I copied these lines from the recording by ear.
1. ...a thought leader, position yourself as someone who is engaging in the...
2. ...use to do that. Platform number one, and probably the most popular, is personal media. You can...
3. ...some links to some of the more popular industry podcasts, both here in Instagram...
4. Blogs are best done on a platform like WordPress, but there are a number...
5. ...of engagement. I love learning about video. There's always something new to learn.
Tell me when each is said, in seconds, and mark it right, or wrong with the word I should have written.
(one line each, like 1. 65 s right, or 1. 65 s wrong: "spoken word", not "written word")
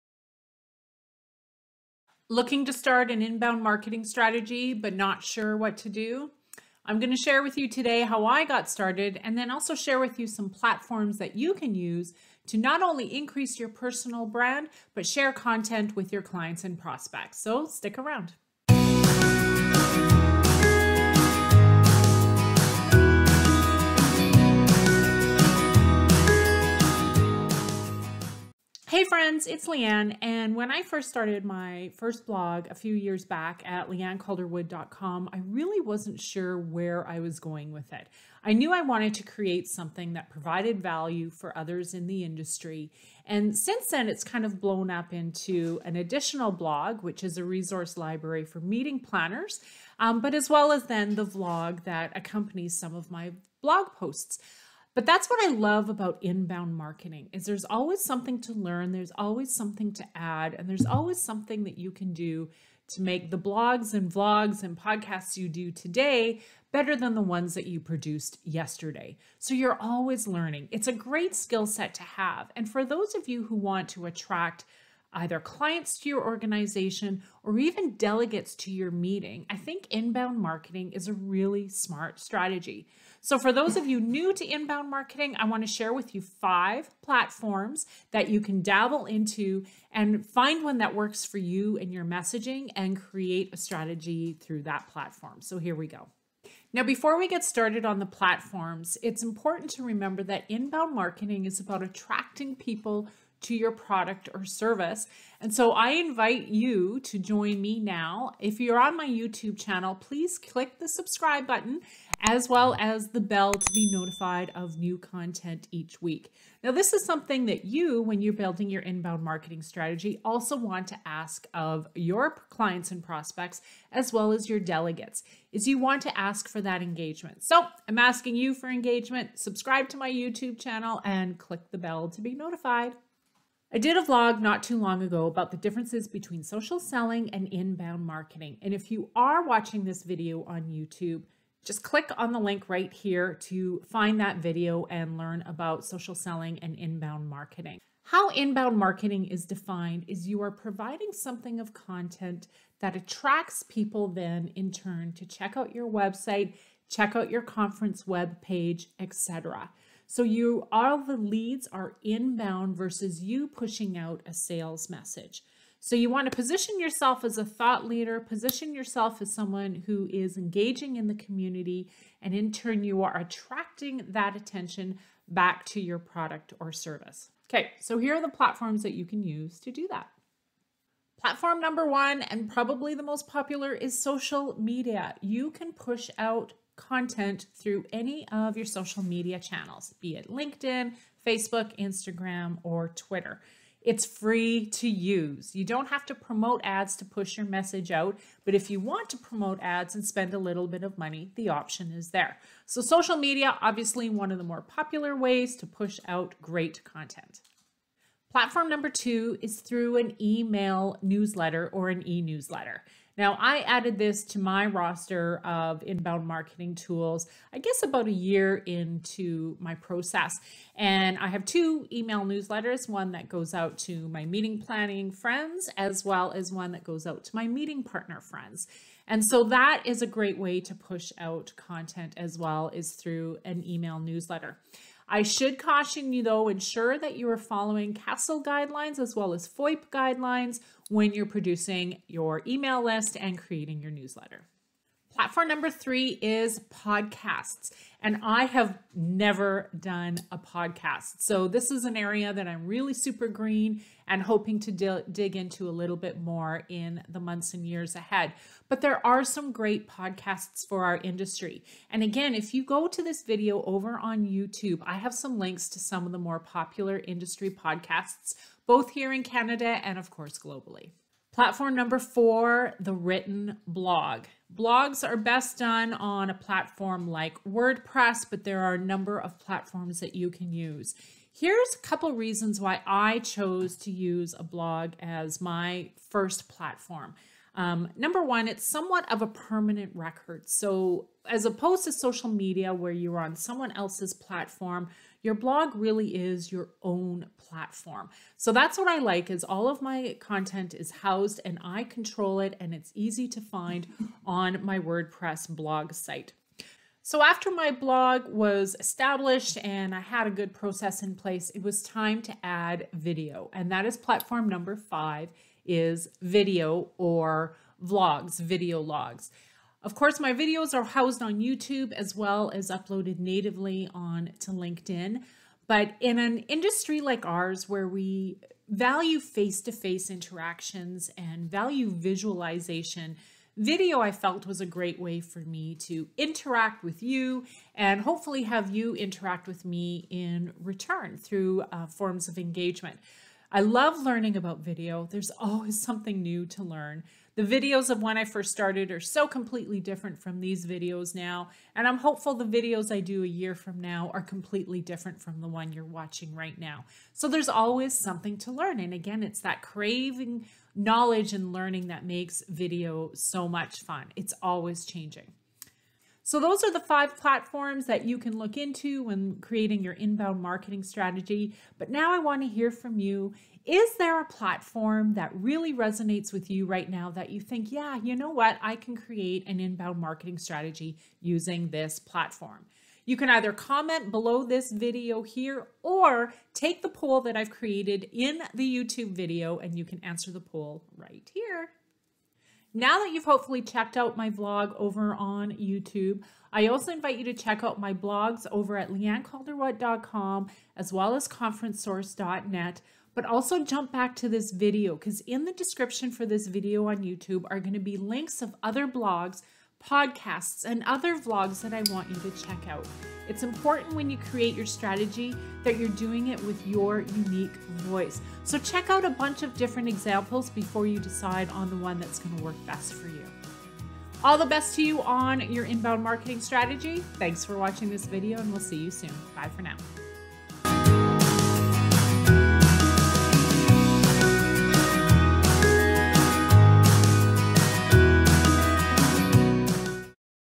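1. 167 s right
2. 179 s wrong: "social", not "personal"
3. 265 s wrong: "Canada", not "Instagram"
4. 274 s right
5. 342 s right.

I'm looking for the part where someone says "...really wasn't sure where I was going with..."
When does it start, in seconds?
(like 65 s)
35 s.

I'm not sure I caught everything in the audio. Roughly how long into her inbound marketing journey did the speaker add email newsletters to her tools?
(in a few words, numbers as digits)
about a year.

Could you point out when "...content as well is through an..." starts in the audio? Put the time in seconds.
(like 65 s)
231 s.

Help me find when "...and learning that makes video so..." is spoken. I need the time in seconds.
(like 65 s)
361 s.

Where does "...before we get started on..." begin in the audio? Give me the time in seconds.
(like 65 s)
96 s.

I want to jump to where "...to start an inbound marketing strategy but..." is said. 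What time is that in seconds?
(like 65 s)
2 s.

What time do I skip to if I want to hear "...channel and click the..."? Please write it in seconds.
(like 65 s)
130 s.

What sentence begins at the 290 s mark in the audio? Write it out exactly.
So, as opposed to social media where you're on someone else's platform, your blog really is your own platform.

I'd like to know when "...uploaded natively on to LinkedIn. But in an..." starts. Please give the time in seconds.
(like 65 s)
322 s.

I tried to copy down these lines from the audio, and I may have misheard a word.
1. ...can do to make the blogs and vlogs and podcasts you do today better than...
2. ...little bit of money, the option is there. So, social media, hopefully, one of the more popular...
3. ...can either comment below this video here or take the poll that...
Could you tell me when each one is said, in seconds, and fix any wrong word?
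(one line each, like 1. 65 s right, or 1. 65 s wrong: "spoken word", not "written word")
1. 61 s right
2. 200 s wrong: "obviously", not "hopefully"
3. 383 s right.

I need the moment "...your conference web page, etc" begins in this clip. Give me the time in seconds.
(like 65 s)
157 s.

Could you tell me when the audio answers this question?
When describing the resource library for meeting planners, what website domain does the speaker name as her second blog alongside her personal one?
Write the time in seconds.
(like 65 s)
401 s.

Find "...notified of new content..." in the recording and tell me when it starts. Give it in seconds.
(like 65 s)
113 s.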